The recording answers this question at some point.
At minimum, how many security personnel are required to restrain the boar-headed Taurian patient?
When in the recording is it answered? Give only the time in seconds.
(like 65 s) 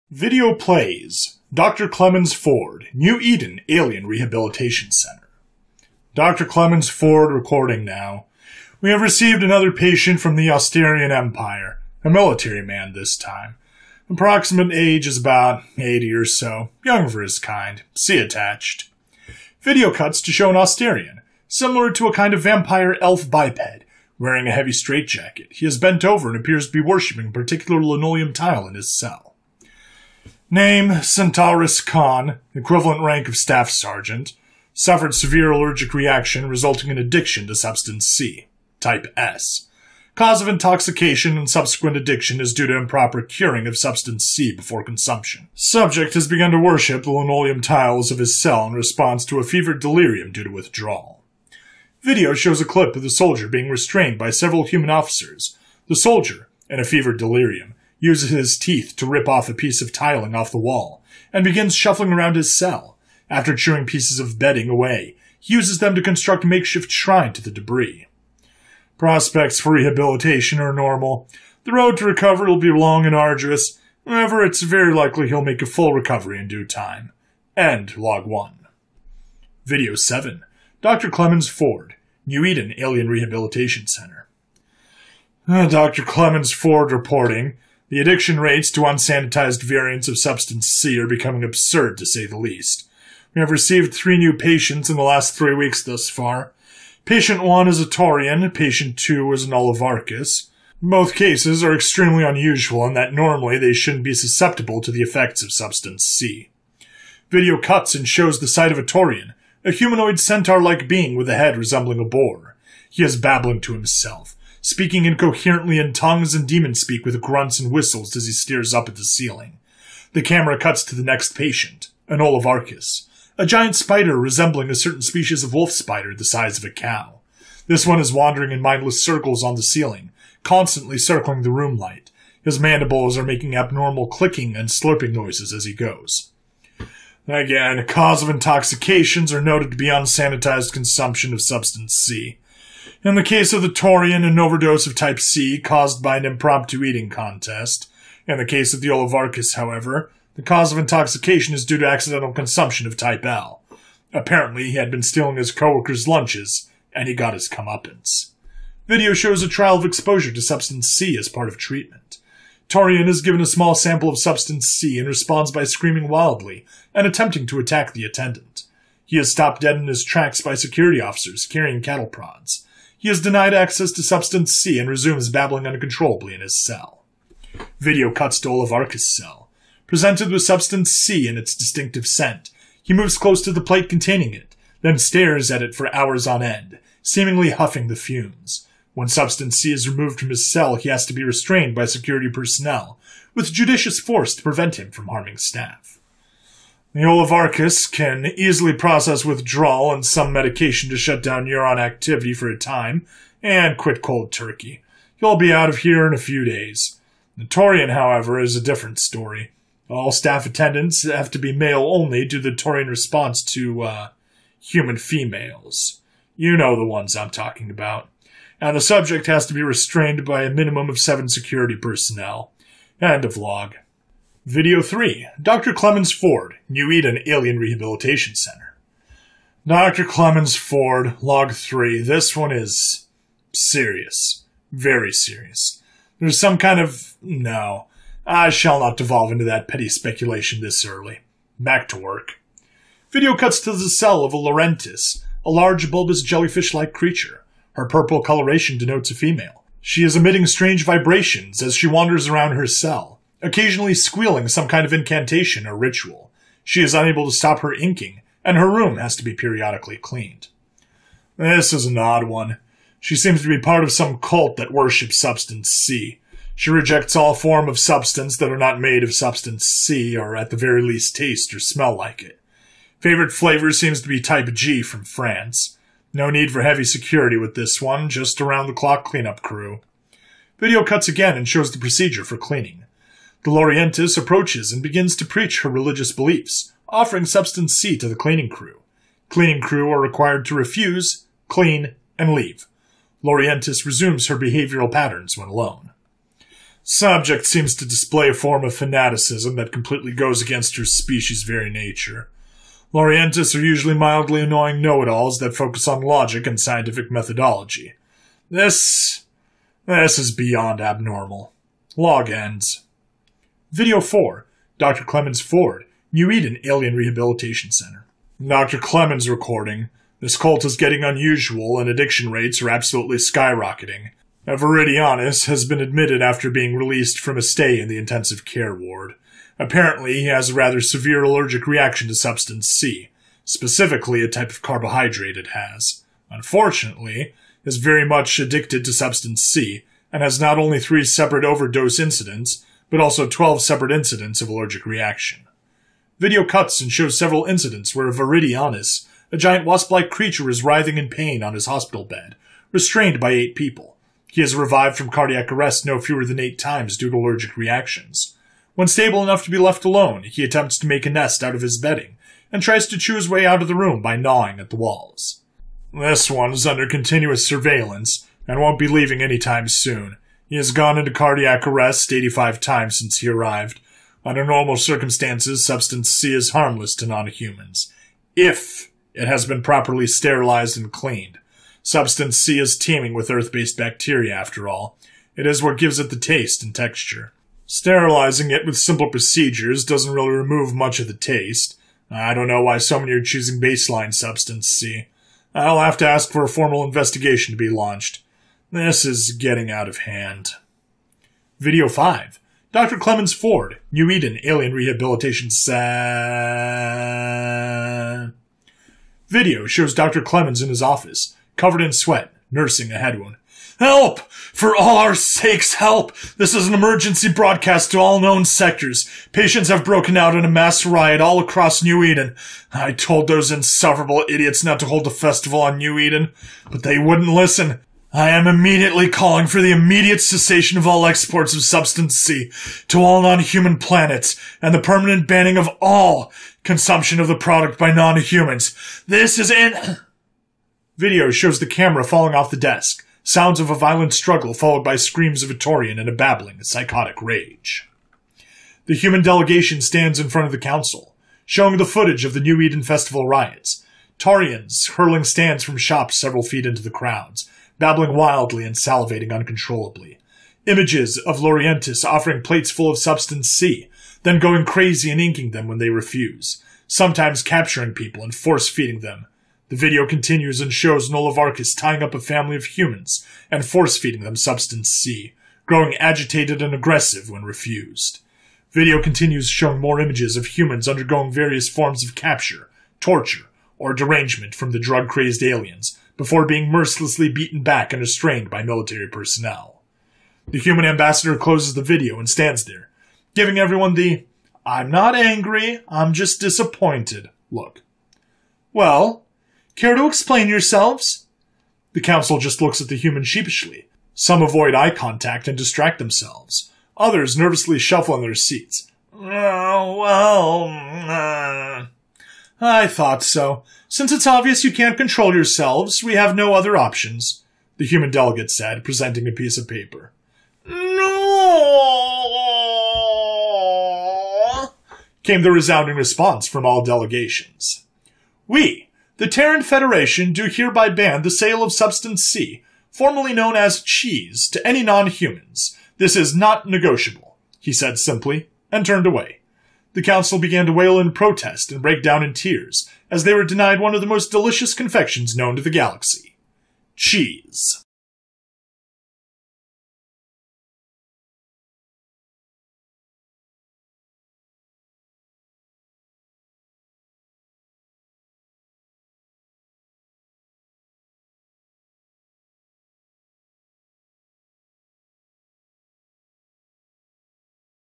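220 s.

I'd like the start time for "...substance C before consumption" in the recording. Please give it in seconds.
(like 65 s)
43 s.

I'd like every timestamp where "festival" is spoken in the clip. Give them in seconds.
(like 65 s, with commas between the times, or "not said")
425 s, 452 s.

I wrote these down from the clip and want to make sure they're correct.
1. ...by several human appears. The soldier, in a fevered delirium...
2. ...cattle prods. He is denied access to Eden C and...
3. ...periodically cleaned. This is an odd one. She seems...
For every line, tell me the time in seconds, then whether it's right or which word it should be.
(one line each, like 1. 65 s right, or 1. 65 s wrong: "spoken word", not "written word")
1. 54 s wrong: "officers", not "appears"
2. 171 s wrong: "Substance", not "Eden"
3. 259 s right.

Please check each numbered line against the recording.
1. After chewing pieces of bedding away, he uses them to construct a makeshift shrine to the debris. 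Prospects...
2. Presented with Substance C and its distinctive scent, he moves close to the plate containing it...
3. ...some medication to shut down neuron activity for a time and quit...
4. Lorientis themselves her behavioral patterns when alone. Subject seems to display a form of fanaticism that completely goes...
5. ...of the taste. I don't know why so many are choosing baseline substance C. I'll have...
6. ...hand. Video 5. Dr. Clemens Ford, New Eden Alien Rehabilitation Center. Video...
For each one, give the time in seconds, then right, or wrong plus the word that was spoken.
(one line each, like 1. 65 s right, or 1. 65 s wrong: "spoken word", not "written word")
1. 63 s right
2. 179 s right
3. 200 s right
4. 293 s wrong: "resumes", not "themselves"
5. 390 s right
6. 399 s right.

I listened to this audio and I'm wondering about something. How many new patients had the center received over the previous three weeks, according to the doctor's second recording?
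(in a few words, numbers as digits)
3.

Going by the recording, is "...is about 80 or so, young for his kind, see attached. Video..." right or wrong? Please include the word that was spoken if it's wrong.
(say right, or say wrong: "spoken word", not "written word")
right.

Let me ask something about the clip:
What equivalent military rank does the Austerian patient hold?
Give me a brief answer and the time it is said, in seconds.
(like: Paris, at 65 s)
Staff Sergeant, at 33 s.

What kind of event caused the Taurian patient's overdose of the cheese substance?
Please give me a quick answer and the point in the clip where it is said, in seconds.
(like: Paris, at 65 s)
An impromptu eating contest, at 146 s.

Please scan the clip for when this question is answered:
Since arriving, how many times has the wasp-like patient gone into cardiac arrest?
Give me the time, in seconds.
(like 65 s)
372 s.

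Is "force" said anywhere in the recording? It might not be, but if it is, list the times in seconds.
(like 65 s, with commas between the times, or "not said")
193 s, 468 s, 473 s.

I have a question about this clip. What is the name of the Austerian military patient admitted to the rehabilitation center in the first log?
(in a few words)
Centaurus Khan.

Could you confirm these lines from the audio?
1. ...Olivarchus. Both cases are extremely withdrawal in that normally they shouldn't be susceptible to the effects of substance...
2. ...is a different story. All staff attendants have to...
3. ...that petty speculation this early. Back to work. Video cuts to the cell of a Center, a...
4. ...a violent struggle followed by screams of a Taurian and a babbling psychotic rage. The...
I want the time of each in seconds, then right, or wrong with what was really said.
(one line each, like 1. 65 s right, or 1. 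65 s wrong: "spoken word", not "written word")
1. 99 s wrong: "unusual", not "withdrawal"
2. 208 s right
3. 239 s wrong: "Lorientis", not "Center"
4. 443 s right.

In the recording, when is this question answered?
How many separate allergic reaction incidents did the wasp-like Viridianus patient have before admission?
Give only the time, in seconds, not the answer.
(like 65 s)
343 s.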